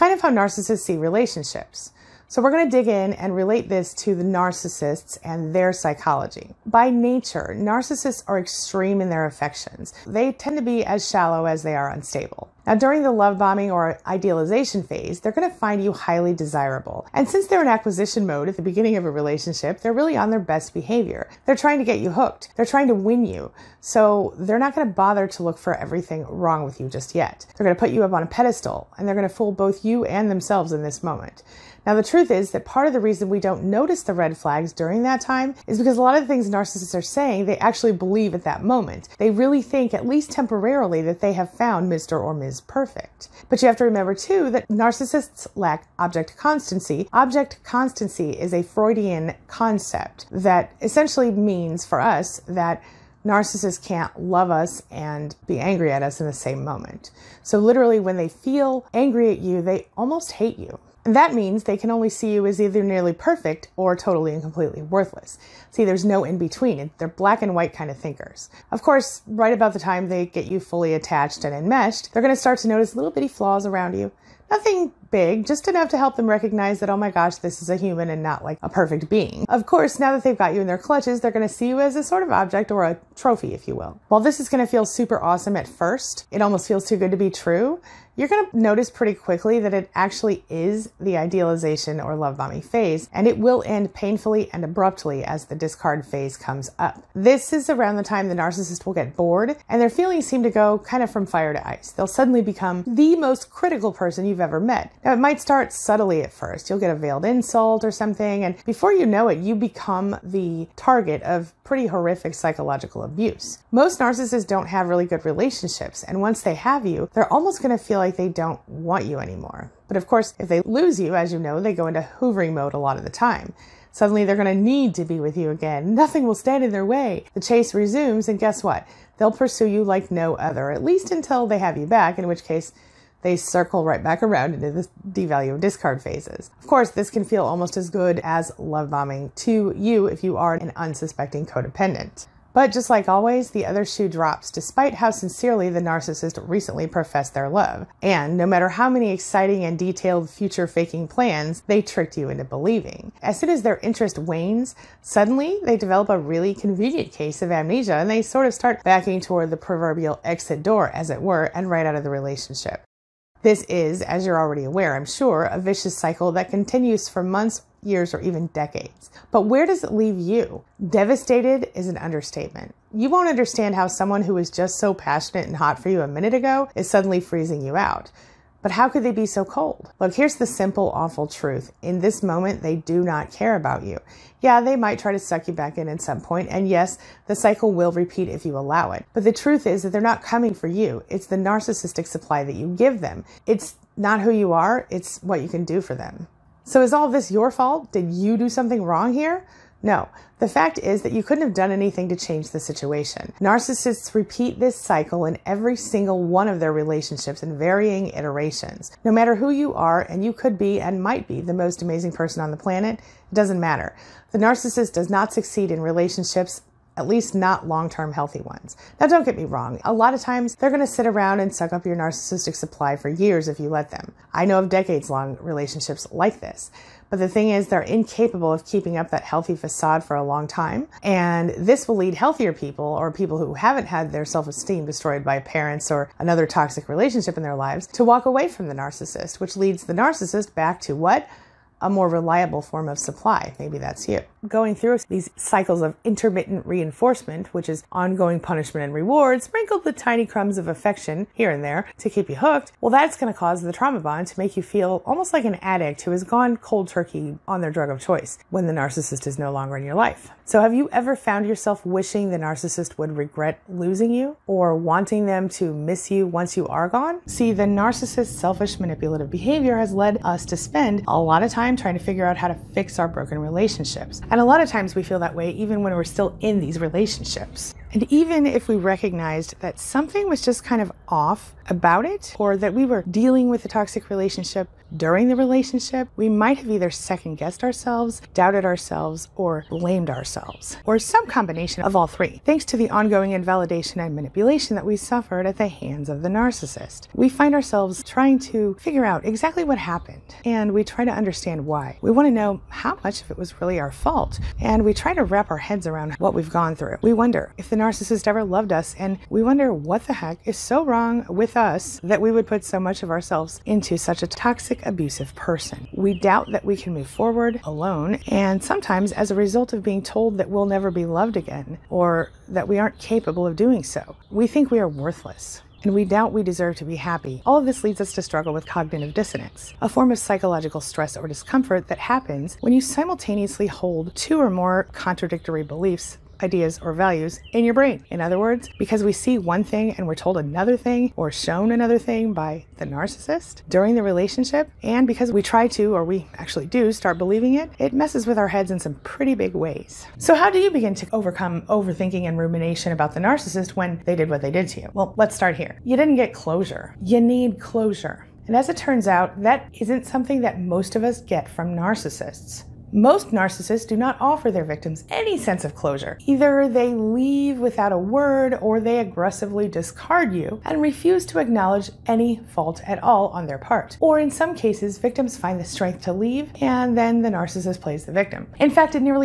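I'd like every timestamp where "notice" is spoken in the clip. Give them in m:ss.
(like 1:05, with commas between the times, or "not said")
0:33, 1:12, 1:28.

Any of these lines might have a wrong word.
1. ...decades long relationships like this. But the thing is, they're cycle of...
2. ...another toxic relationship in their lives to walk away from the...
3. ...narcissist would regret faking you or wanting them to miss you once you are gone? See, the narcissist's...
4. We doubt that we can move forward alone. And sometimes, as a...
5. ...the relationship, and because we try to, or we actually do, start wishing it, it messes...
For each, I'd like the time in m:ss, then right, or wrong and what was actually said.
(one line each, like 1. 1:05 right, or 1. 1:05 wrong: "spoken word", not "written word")
1. 3:44 wrong: "incapable", not "cycle"
2. 3:56 right
3. 4:22 wrong: "losing", not "faking"
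4. 5:15 right
5. 5:43 wrong: "believing", not "wishing".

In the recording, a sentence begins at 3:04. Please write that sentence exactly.
Yeah, they might try to suck you back in at some point, and yes, the cycle will repeat if you allow it.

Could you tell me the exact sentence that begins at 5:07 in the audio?
We wonder if the narcissist ever loved us.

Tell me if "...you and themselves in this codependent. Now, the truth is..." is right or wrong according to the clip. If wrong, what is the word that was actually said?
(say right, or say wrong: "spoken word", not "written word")
wrong: "moment", not "codependent".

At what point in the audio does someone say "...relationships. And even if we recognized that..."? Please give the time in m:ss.
4:36.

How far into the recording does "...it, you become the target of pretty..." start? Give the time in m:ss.
1:49.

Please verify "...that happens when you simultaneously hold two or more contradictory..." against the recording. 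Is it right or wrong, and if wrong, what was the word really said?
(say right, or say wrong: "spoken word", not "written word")
right.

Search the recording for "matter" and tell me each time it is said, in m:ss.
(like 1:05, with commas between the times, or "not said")
2:28, 3:29, 3:33.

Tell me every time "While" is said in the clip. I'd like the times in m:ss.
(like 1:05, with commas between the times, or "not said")
1:24.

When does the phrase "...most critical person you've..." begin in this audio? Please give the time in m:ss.
1:43.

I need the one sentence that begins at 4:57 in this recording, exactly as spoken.
We find ourselves trying to figure out exactly what happened, and we try to understand why.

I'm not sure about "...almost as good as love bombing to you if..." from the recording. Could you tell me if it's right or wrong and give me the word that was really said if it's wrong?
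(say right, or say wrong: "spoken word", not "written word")
right.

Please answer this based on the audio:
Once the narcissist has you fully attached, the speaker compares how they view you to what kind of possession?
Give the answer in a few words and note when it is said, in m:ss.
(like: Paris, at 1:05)
A trophy, at 1:22.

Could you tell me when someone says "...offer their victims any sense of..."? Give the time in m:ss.
6:04.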